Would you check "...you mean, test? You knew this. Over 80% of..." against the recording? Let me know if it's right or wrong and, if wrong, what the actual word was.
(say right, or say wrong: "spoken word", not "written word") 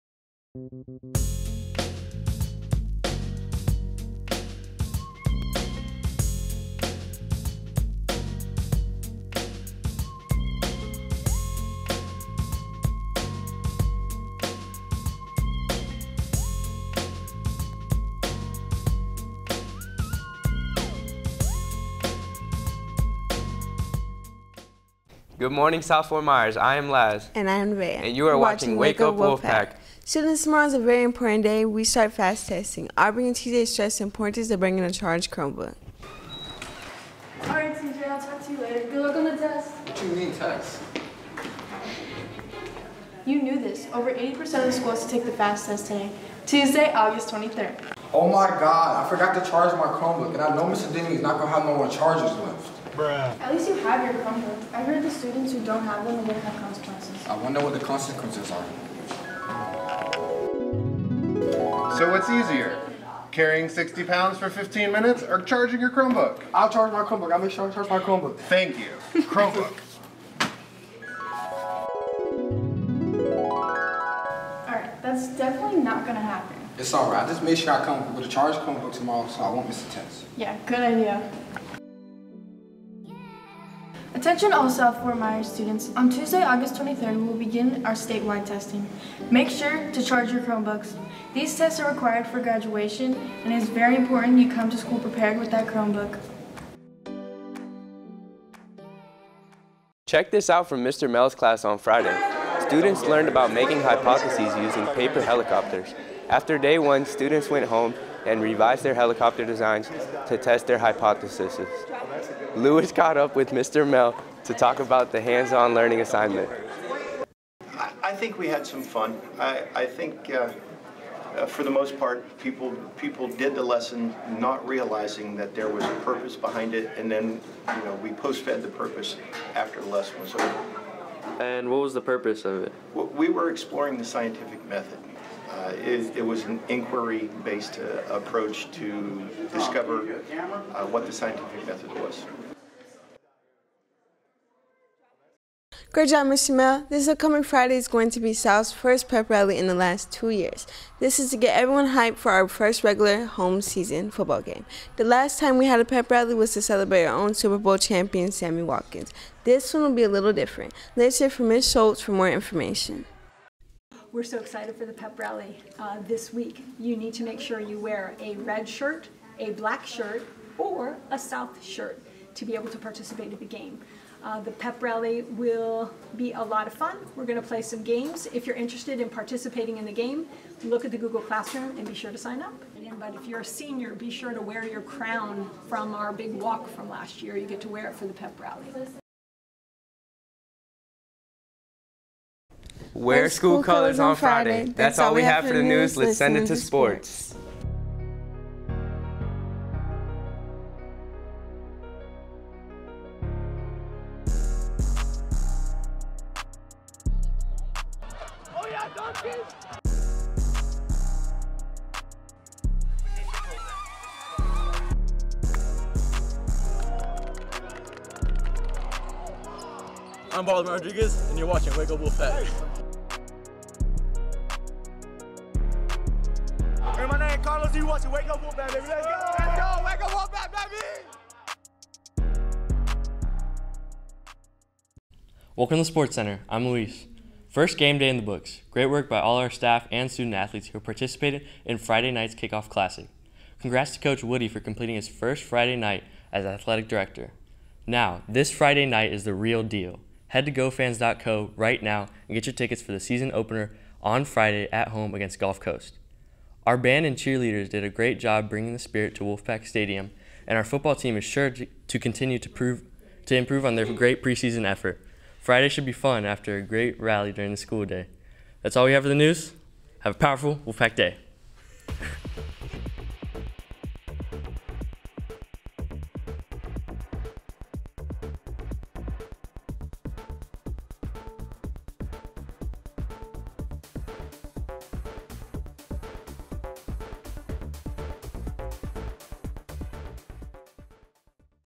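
right.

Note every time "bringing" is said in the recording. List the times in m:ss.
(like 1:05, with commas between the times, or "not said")
0:34, 4:18.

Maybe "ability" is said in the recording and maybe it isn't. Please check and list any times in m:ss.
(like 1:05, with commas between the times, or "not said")
not said.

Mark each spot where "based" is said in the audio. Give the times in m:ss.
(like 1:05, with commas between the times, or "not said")
2:16.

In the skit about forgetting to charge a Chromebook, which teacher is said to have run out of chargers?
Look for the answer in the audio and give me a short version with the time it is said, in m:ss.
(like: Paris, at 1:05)
Mr. Denny, at 0:50.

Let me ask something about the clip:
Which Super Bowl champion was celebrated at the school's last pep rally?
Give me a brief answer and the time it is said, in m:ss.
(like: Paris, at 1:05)
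Sammy Watkins, at 2:38.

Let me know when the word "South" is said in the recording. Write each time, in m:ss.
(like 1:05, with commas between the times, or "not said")
0:25, 1:24, 2:28, 2:51.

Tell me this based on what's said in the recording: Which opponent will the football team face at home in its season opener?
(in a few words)
Gulf Coast.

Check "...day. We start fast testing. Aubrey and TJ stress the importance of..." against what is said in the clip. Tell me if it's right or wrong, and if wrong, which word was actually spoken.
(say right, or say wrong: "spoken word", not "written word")
right.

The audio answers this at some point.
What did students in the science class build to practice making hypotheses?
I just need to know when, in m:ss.
1:44.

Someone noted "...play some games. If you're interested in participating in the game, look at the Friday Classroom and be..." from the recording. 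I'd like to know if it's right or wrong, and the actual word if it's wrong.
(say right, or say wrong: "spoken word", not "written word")
wrong: "Google", not "Friday".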